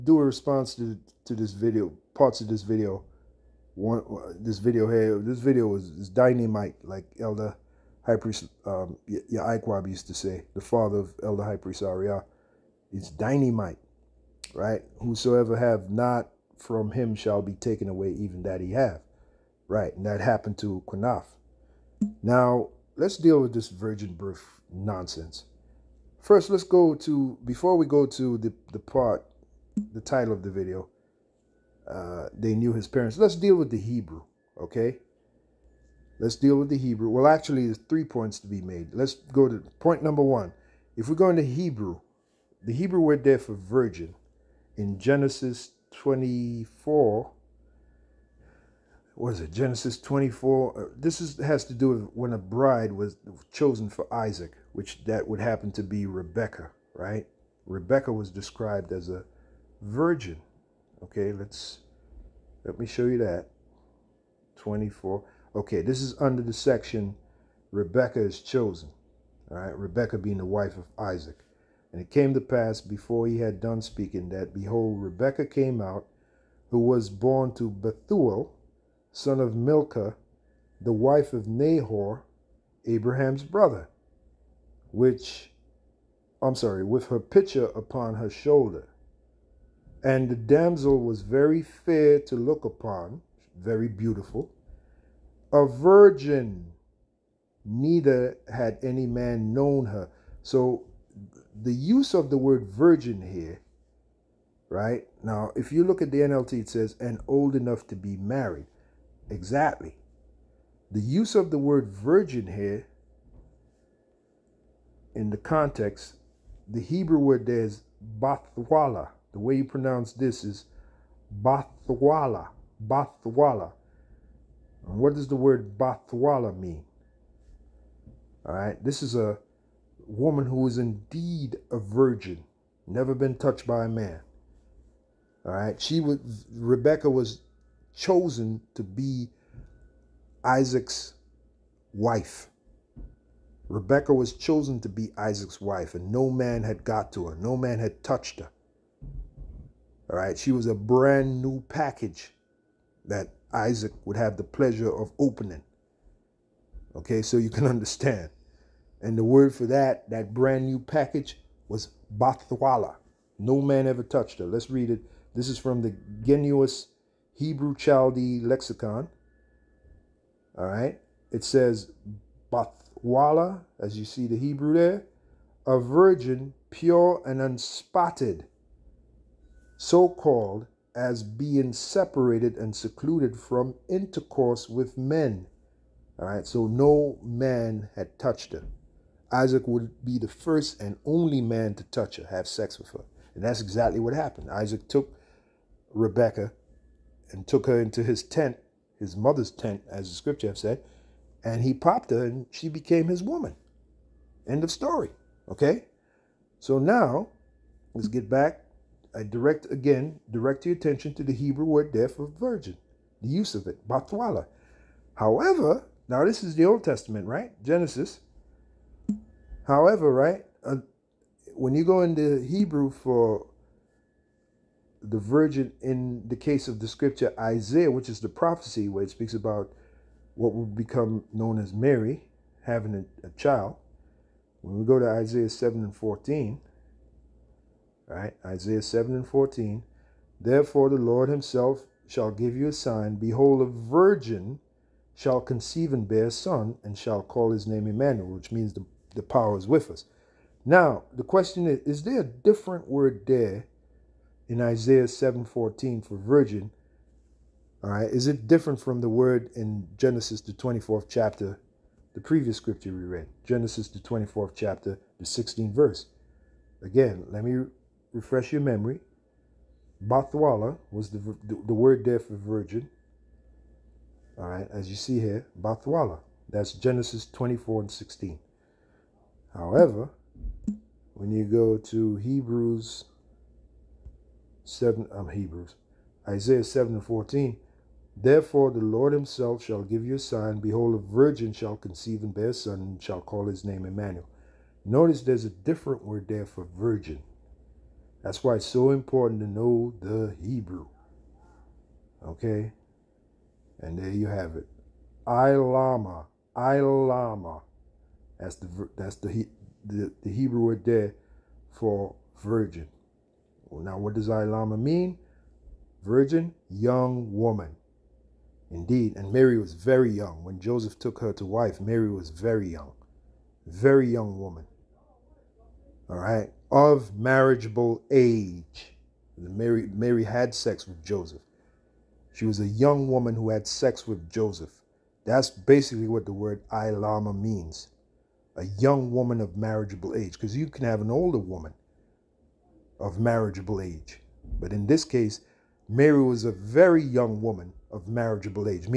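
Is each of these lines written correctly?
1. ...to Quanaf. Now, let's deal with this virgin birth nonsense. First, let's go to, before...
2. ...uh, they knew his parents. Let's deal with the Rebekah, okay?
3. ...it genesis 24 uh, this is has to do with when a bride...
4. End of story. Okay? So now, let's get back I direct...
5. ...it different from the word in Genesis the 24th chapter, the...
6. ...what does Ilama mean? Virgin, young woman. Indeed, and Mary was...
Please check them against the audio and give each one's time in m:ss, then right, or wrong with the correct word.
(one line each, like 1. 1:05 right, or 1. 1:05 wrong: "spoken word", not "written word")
1. 0:20 right
2. 0:31 wrong: "Hebrew", not "Rebekah"
3. 0:49 right
4. 3:24 right
5. 4:18 right
6. 5:13 right.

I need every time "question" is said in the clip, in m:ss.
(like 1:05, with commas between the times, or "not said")
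4:11.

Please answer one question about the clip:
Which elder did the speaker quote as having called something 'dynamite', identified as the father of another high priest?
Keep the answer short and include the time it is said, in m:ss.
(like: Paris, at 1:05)
Yaakwab, at 0:09.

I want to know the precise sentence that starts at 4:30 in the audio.
Bathwala was the, the, the word there for virgin.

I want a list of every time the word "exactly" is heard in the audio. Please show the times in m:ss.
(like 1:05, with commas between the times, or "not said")
1:49, 3:13.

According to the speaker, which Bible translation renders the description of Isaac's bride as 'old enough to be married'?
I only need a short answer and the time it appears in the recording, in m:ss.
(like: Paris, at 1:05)
NLT, at 1:46.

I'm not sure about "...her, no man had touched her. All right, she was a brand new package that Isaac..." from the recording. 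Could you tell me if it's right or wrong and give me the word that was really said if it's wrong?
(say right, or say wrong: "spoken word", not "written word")
right.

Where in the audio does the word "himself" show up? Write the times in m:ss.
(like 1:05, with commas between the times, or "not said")
4:01, 4:49.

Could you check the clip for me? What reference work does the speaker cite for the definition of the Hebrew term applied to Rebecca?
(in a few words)
Gesenius Hebrew Chaldee Lexicon.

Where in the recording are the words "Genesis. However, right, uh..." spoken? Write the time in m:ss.
3:37.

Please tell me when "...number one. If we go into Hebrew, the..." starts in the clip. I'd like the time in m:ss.
0:40.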